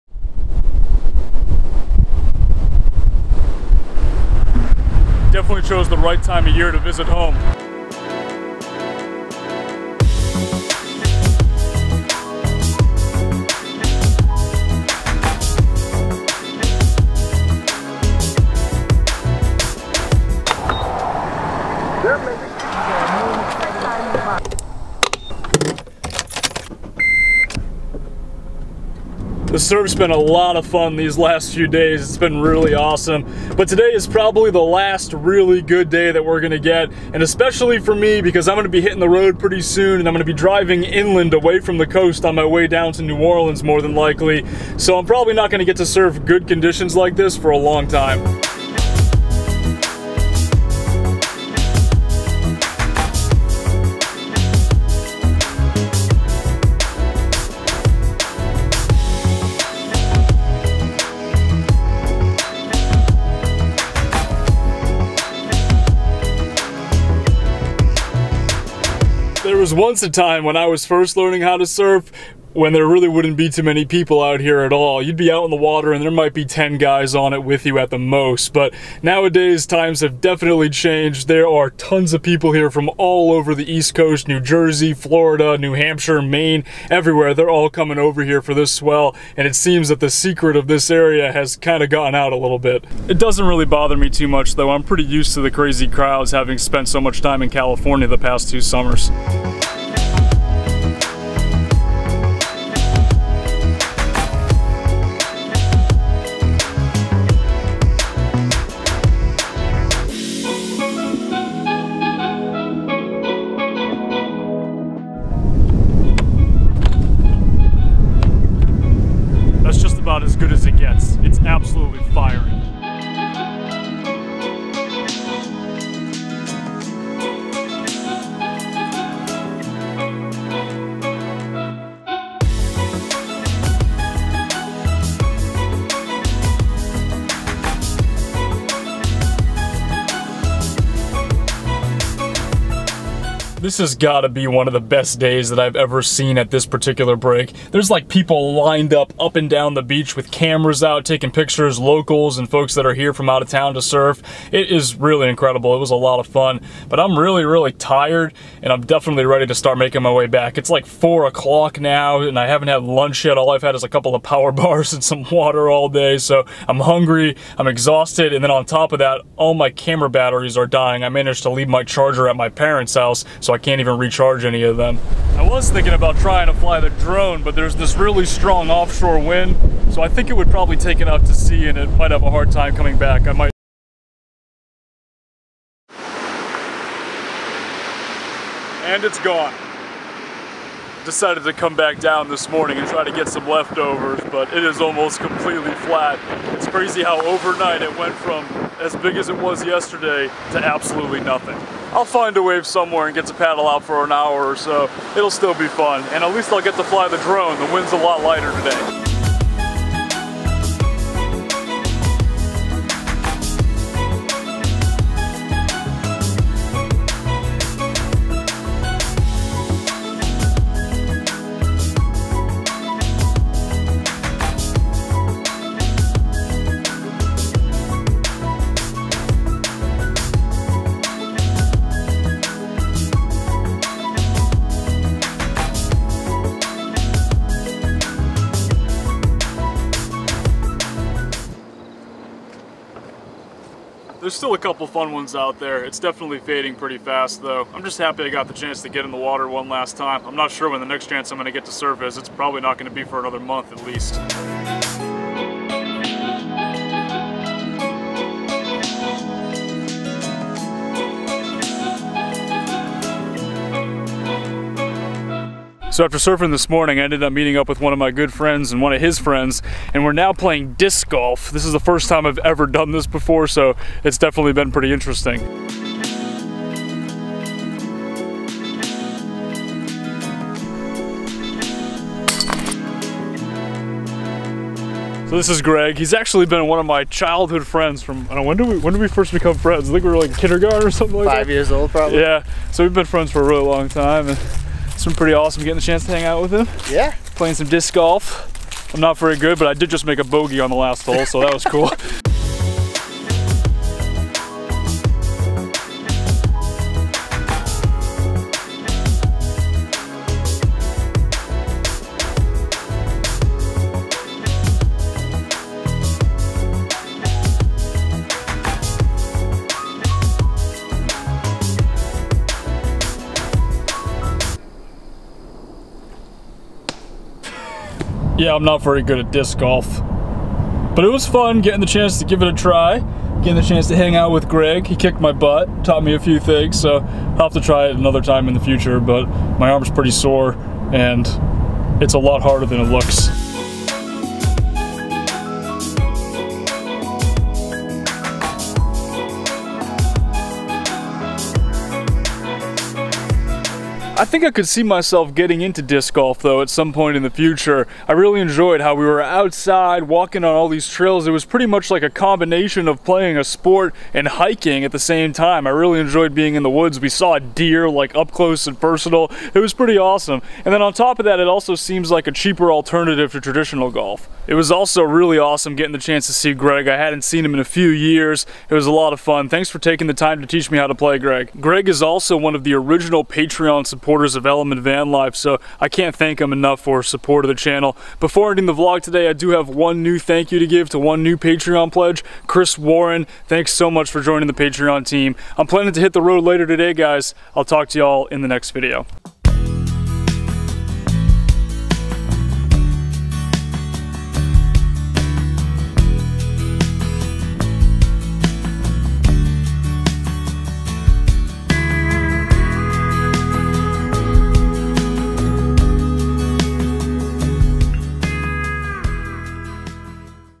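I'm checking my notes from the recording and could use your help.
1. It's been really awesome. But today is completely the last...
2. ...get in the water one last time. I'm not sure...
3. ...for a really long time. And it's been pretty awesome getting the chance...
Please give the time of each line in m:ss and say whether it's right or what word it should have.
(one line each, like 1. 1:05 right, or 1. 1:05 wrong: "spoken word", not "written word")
1. 0:32 wrong: "probably", not "completely"
2. 4:08 right
3. 4:53 right.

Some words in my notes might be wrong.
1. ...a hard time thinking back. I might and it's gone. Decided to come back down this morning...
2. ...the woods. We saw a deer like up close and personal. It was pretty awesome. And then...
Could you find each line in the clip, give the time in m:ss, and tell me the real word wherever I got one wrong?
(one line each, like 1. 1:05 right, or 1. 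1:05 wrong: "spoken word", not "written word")
1. 3:02 wrong: "coming", not "thinking"
2. 6:06 right.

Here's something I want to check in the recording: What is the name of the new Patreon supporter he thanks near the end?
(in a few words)
Chris Warren.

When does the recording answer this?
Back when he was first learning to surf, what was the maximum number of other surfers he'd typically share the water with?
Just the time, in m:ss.
1:16.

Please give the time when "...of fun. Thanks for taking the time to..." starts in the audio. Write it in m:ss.
6:19.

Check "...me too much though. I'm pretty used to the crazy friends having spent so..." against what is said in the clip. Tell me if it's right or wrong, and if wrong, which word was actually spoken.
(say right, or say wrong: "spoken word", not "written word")
wrong: "crowds", not "friends".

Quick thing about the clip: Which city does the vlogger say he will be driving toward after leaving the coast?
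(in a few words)
New Orleans.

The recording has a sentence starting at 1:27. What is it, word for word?
They're all coming over here for this swell.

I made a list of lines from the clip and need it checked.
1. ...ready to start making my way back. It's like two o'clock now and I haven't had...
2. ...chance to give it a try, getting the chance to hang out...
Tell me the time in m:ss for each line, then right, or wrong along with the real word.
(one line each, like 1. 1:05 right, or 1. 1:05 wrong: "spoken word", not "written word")
1. 2:39 wrong: "four", not "two"
2. 5:31 right.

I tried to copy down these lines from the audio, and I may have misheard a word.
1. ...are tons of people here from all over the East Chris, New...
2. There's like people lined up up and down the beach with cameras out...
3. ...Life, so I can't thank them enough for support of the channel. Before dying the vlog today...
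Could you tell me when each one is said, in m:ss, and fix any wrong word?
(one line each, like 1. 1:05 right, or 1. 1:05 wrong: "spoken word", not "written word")
1. 1:21 wrong: "Coast", not "Chris"
2. 2:27 right
3. 6:25 wrong: "ending", not "dying".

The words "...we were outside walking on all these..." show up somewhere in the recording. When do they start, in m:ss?
5:58.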